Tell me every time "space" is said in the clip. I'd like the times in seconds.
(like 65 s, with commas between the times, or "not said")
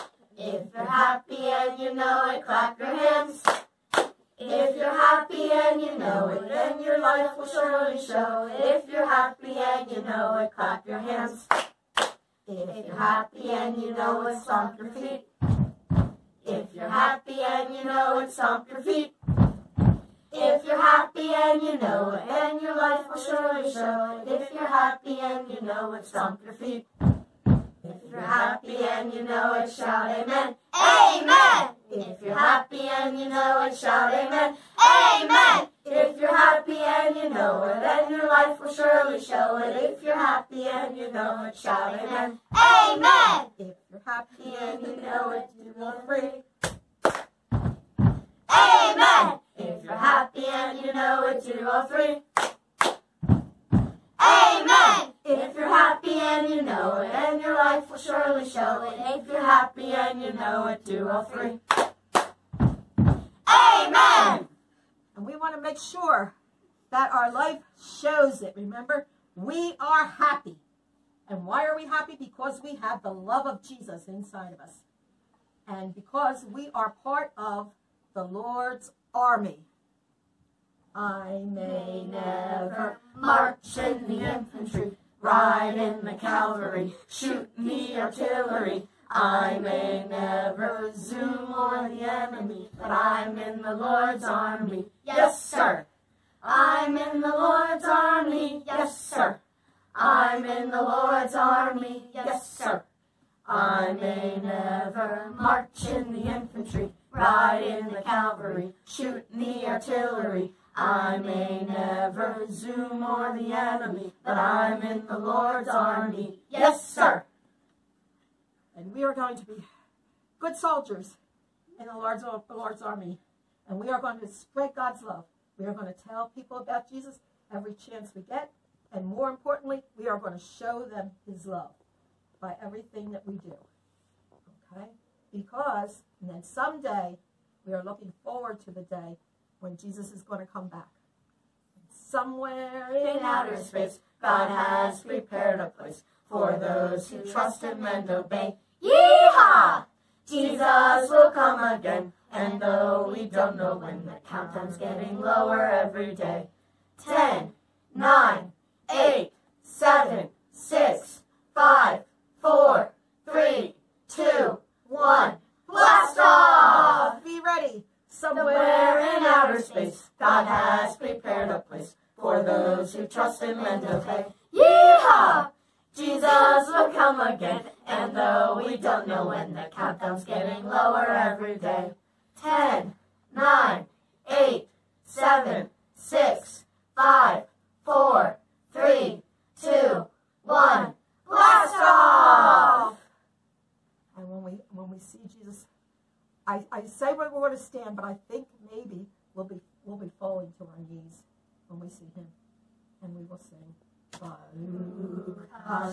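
143 s, 169 s.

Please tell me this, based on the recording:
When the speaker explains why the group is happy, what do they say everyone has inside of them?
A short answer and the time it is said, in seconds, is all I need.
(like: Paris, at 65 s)
The love of Jesus, at 73 s.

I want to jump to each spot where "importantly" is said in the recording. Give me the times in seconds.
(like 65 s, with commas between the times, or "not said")
129 s.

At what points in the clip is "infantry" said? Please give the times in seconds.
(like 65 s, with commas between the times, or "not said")
84 s, 106 s.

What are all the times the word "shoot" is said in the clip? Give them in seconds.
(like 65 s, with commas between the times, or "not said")
87 s, 108 s.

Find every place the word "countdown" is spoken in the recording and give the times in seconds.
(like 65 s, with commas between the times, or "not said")
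154 s, 179 s.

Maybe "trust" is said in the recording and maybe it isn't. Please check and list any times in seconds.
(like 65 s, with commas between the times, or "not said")
147 s, 173 s.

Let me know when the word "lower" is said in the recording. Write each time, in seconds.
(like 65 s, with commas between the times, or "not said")
155 s, 180 s.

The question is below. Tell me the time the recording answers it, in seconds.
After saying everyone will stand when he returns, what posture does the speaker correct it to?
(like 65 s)
200 s.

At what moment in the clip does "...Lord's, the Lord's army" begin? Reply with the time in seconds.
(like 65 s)
121 s.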